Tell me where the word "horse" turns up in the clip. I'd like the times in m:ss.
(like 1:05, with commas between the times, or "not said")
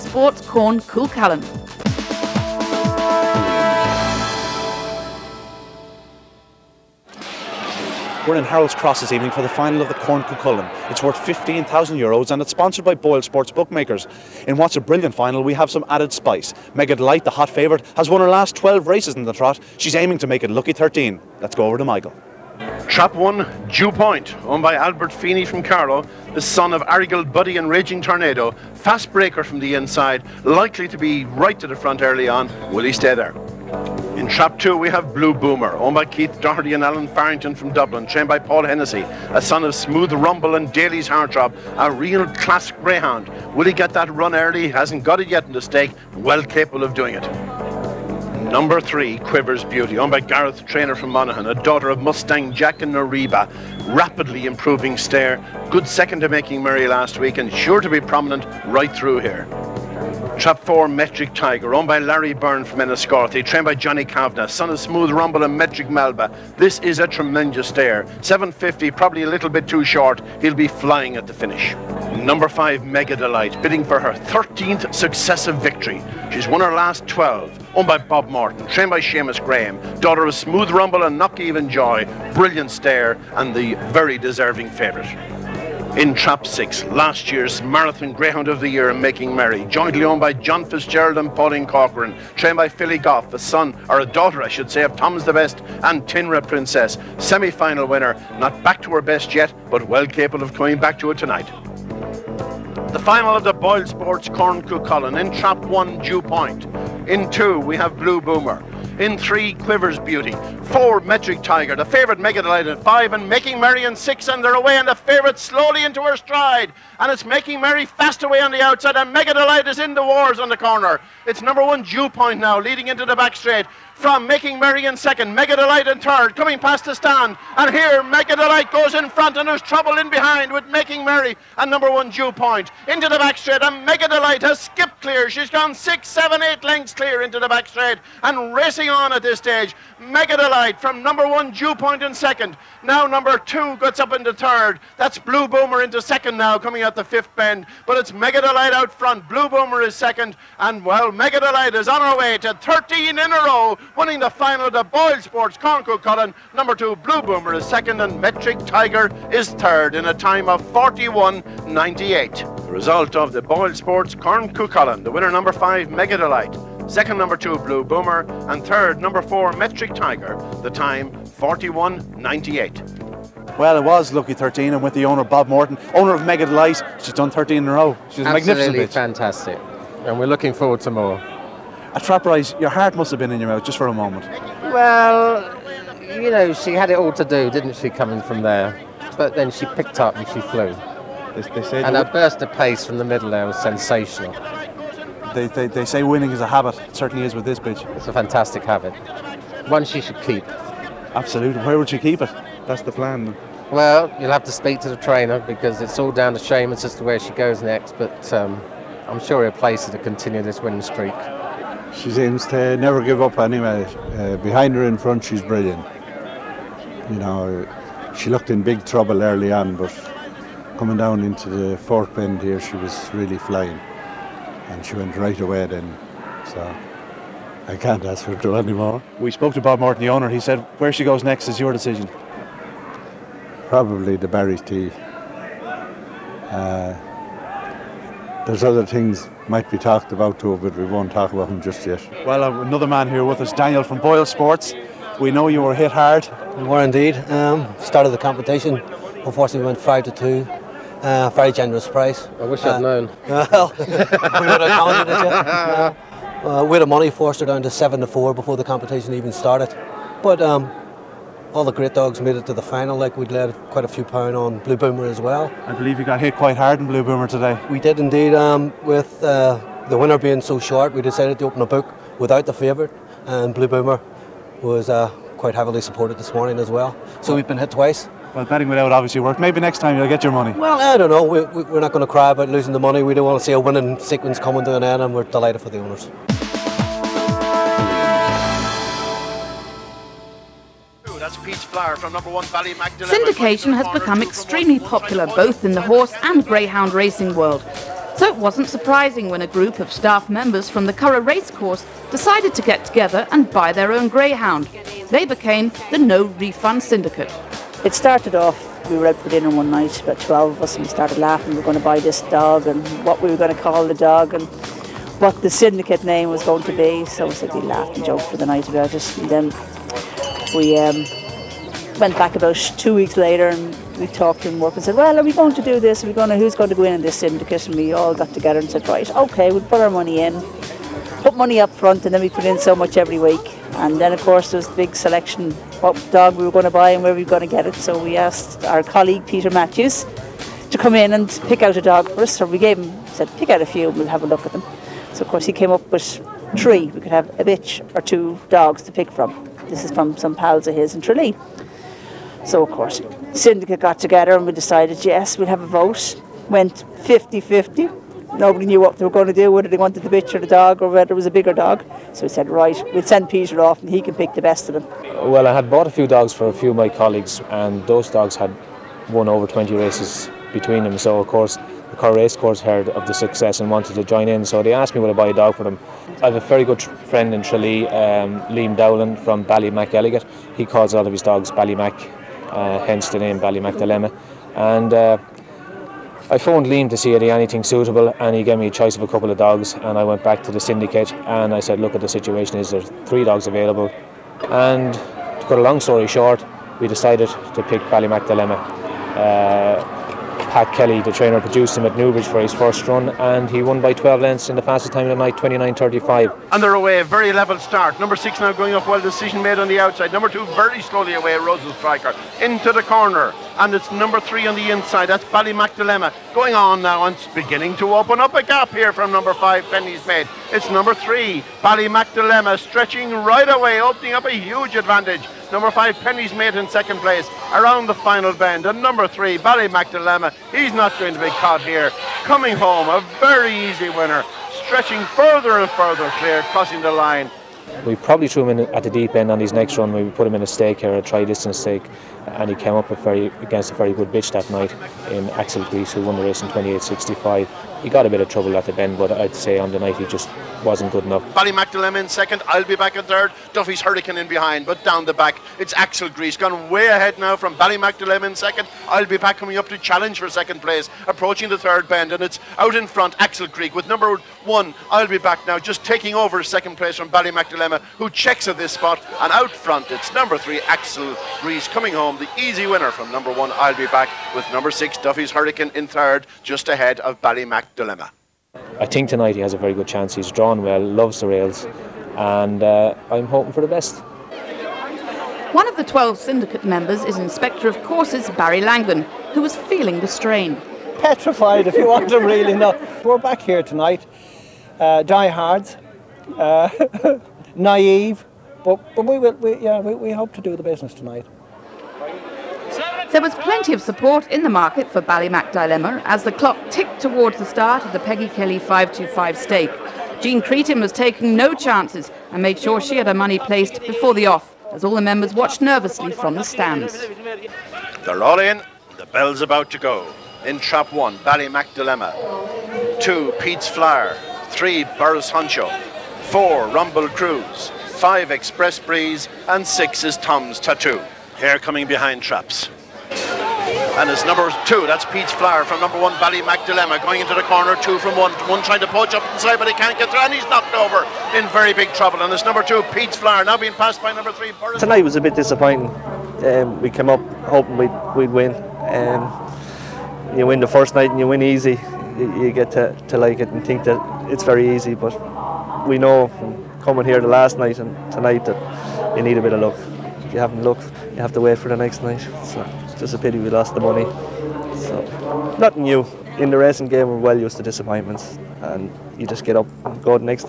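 4:55.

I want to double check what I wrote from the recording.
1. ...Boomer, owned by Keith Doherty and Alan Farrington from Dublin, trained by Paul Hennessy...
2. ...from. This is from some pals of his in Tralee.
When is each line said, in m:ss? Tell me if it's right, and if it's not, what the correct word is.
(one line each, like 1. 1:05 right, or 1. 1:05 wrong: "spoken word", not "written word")
1. 0:35 right
2. 5:49 right.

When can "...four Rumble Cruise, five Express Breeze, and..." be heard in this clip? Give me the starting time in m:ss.
8:46.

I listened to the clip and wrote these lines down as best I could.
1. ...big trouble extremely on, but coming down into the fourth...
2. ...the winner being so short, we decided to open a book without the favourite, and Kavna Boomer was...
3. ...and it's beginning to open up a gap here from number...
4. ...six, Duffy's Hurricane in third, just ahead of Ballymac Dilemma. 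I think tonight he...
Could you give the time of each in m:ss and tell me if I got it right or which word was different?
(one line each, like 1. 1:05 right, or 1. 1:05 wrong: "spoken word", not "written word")
1. 3:38 wrong: "early", not "extremely"
2. 4:29 wrong: "Blue", not "Kavna"
3. 6:57 right
4. 7:54 right.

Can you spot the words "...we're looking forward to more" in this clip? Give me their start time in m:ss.
3:00.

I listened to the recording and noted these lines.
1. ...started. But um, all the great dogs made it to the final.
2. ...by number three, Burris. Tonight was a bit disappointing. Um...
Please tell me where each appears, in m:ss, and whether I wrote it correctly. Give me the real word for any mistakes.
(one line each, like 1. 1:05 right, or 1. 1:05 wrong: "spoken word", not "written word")
1. 4:19 right
2. 9:04 right.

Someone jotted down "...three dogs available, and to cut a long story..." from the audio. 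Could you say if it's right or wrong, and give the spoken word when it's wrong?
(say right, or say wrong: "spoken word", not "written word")
right.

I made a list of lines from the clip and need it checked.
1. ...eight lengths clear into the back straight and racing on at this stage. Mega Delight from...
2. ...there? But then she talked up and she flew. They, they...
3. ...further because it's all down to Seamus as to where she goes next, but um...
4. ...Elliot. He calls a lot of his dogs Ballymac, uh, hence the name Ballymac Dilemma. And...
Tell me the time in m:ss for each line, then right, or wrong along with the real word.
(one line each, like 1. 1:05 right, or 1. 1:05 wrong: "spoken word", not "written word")
1. 2:16 right
2. 3:08 wrong: "picked", not "talked"
3. 3:24 wrong: "trainer", not "further"
4. 6:19 right.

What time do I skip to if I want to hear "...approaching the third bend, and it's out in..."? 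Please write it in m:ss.
7:41.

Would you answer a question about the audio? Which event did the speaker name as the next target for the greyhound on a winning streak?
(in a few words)
The Barry's Tea.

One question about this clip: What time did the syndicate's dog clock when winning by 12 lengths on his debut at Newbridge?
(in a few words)
29.35.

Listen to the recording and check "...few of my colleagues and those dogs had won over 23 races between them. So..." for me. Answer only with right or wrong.
wrong.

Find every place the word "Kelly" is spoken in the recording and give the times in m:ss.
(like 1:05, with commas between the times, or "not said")
6:40, 8:28.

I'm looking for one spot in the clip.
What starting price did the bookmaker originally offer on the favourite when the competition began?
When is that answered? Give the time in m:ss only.
4:09.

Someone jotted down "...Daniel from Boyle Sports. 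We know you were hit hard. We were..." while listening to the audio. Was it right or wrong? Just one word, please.
right.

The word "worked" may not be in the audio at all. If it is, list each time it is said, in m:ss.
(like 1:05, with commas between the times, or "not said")
4:39, 5:24.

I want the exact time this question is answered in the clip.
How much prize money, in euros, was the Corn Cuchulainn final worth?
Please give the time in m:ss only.
0:11.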